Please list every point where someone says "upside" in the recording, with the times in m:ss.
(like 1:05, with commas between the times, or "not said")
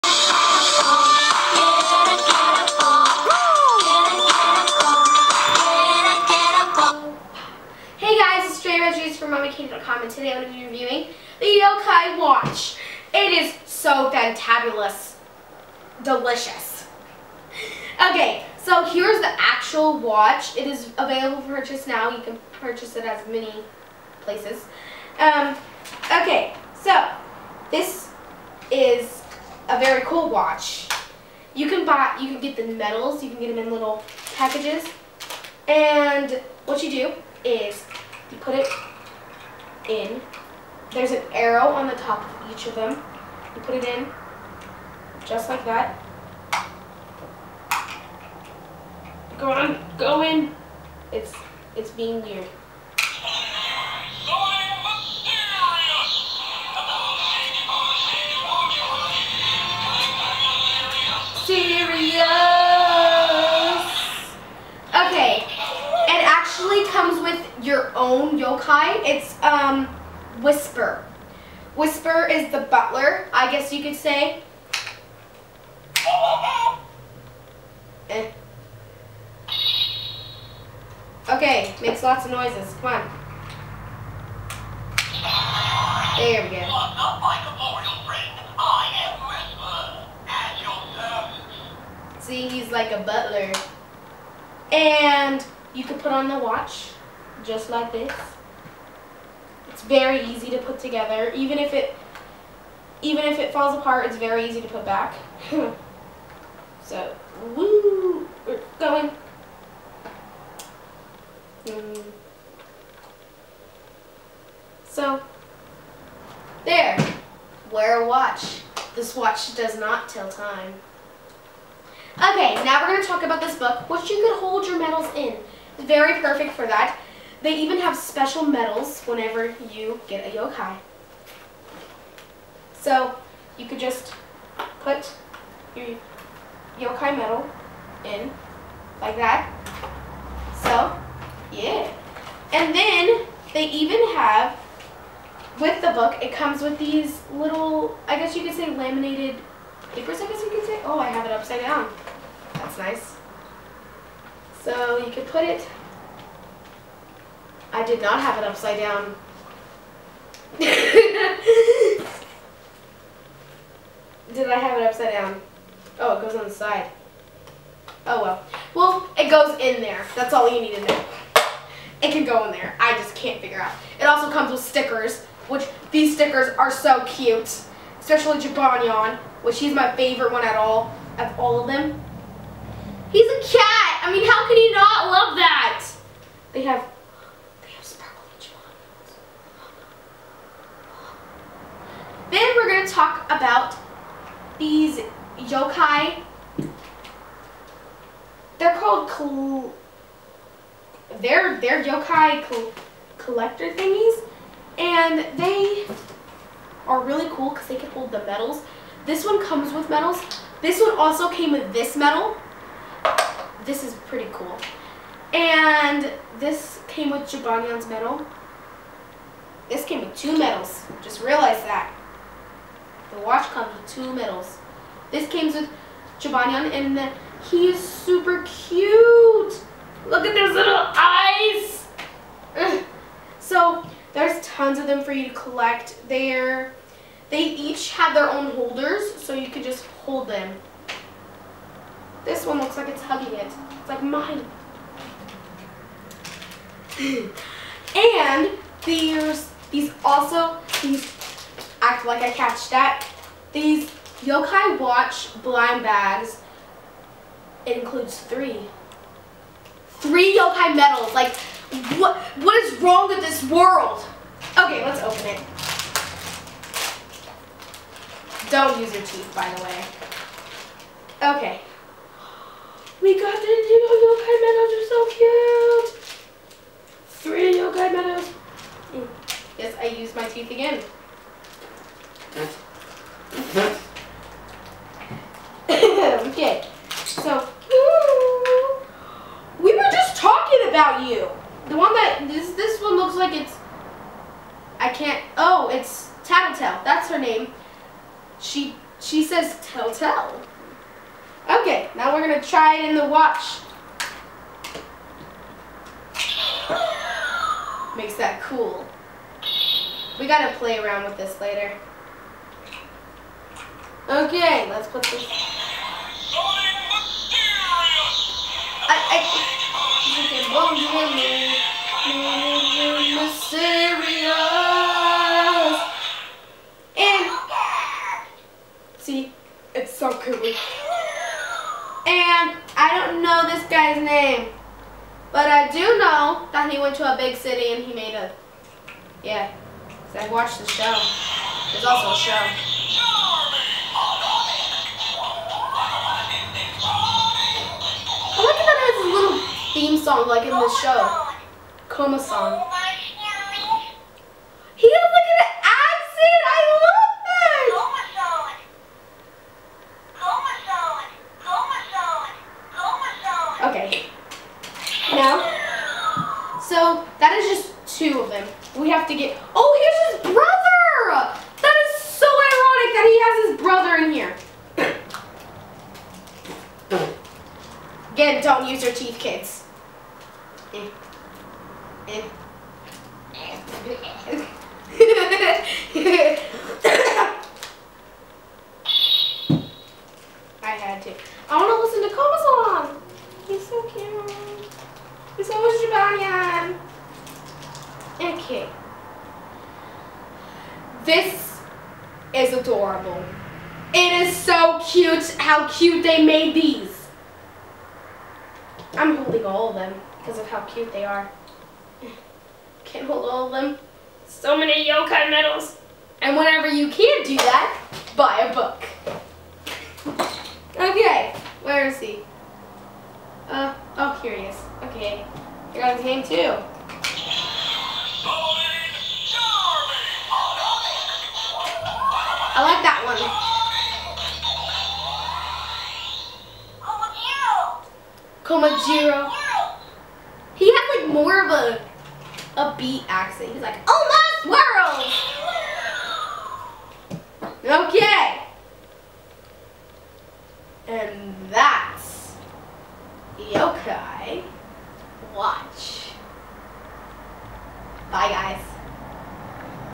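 2:31, 2:38, 2:44.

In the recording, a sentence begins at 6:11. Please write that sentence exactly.
That is so ironic that he has his brother in here.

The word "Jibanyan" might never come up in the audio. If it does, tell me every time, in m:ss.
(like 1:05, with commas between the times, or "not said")
2:58, 3:37.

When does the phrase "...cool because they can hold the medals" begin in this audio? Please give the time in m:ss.
3:27.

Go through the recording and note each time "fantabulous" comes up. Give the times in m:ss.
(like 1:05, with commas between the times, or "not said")
0:14.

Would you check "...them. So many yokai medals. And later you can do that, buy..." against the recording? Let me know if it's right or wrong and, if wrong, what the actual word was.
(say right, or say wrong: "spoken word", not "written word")
wrong: "whenever", not "later".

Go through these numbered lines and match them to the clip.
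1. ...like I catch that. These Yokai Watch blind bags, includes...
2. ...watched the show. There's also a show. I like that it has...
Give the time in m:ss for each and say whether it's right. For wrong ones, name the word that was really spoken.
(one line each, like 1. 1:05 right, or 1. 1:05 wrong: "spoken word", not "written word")
1. 4:12 right
2. 5:40 right.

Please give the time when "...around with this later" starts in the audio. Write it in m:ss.
5:10.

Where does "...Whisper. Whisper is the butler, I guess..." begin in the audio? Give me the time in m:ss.
1:10.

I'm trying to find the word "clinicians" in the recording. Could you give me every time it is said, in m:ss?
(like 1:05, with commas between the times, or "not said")
not said.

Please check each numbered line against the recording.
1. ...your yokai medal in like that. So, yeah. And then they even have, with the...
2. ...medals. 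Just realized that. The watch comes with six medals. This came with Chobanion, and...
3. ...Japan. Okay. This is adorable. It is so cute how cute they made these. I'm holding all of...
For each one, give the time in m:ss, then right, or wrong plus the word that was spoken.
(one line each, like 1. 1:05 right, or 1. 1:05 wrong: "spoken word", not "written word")
1. 2:15 right
2. 3:40 wrong: "two", not "six"
3. 6:35 right.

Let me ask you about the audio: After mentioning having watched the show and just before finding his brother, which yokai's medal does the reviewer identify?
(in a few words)
Komasan.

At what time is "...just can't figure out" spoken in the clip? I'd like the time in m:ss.
2:52.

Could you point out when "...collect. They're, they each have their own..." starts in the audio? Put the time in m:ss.
3:55.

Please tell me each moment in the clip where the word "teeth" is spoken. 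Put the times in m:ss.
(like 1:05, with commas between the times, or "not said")
4:29, 4:40, 6:18.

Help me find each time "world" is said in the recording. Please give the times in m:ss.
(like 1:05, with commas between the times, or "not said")
4:23, 7:24.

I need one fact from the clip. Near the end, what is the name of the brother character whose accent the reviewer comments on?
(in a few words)
Komajiro.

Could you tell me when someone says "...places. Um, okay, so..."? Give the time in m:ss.
0:24.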